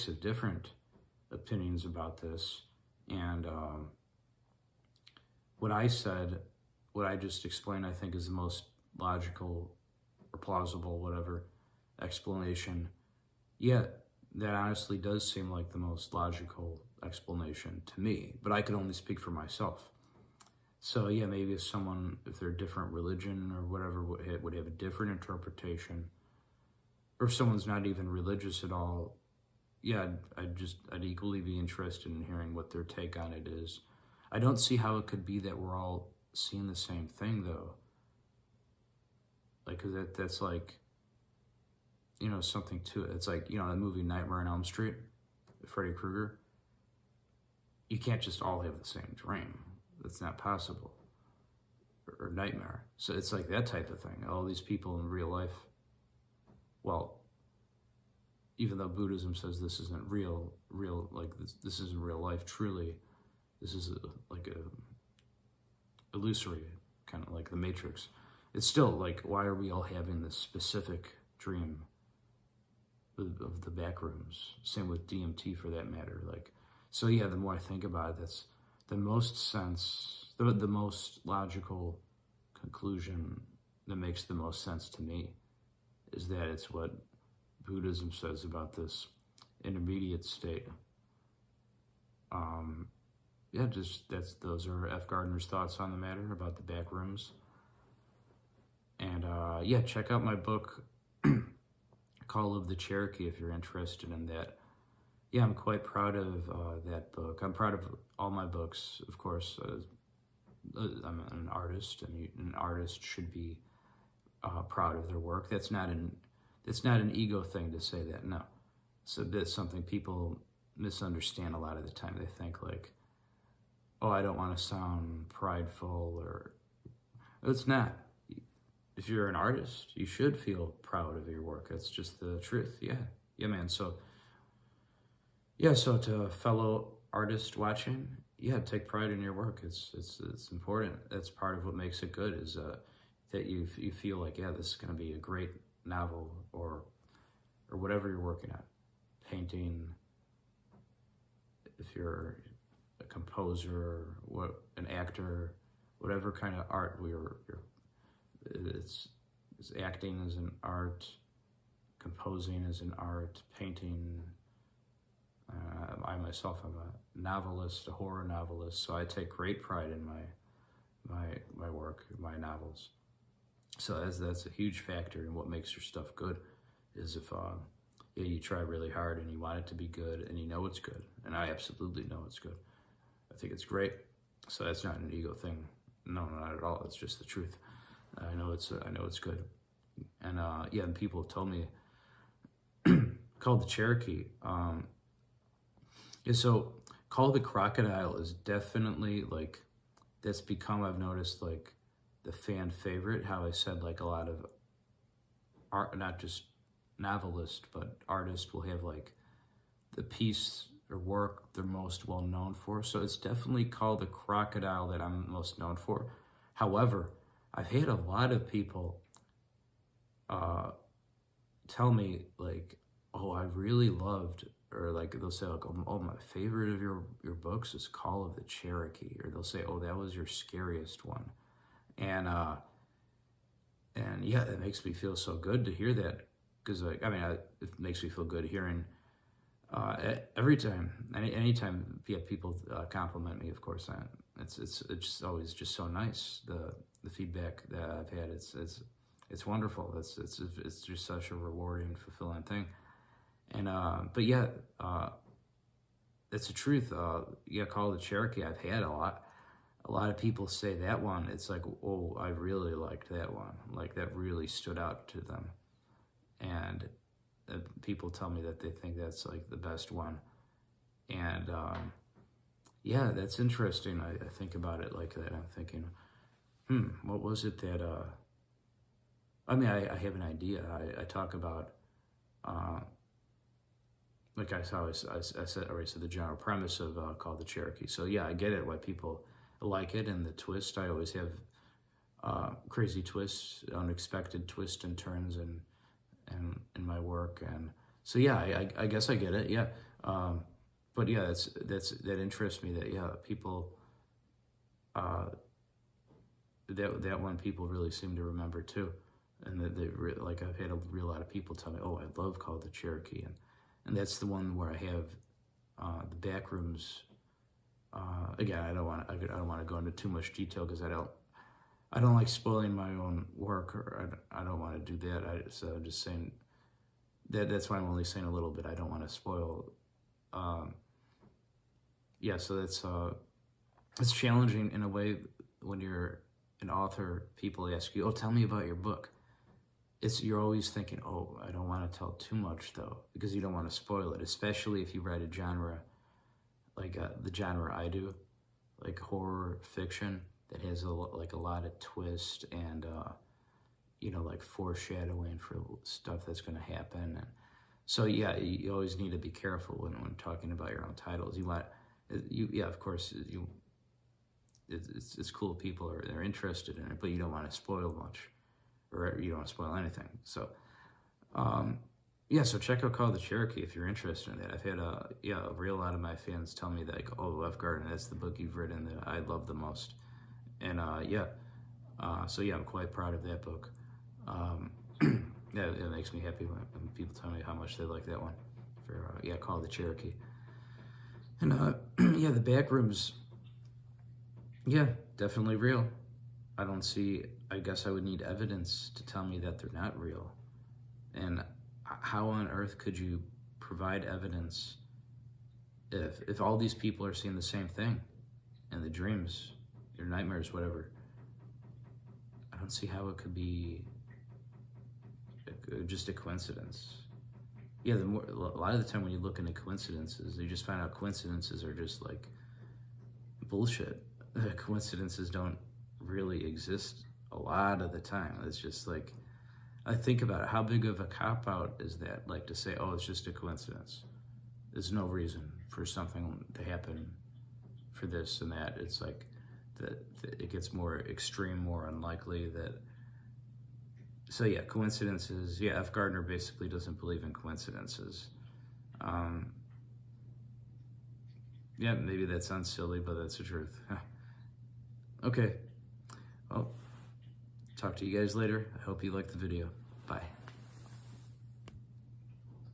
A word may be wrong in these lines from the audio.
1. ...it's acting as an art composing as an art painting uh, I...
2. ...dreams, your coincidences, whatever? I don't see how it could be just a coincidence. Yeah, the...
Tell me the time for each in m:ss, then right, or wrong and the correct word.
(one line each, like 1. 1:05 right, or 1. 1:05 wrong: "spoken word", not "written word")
1. 2:39 right
2. 6:48 wrong: "nightmares", not "coincidences".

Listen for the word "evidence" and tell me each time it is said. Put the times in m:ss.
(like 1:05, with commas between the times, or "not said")
6:38, 6:44.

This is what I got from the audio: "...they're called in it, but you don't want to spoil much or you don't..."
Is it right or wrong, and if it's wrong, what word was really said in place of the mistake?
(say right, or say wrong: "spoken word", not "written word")
wrong: "interested", not "called".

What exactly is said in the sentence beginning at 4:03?
Of course, I, it's it's it's always just so nice the the feedback that I've had.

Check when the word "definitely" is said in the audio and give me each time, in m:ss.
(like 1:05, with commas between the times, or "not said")
3:18, 3:33, 6:35.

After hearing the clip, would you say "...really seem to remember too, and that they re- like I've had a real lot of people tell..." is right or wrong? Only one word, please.
right.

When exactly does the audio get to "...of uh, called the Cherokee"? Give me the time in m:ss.
4:46.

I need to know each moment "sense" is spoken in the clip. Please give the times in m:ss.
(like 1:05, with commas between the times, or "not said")
1:19, 1:24.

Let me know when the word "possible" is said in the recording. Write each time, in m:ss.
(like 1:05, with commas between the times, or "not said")
0:50.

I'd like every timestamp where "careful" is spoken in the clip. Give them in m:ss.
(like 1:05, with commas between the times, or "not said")
5:59.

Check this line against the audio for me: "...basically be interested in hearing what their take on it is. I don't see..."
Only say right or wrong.
wrong.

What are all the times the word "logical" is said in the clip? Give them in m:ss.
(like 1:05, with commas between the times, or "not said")
0:08, 0:16, 1:21.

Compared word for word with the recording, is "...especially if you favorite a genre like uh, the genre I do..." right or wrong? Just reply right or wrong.
wrong.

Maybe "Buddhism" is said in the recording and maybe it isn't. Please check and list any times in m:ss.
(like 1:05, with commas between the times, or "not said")
0:58, 1:27.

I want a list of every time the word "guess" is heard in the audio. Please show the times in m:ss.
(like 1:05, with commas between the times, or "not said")
4:58, 6:37.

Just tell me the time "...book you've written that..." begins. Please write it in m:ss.
6:18.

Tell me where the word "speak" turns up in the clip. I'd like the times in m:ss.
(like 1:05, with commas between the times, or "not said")
0:18.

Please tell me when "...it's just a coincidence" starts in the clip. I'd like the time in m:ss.
7:12.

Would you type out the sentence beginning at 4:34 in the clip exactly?
I, I, think about it like that.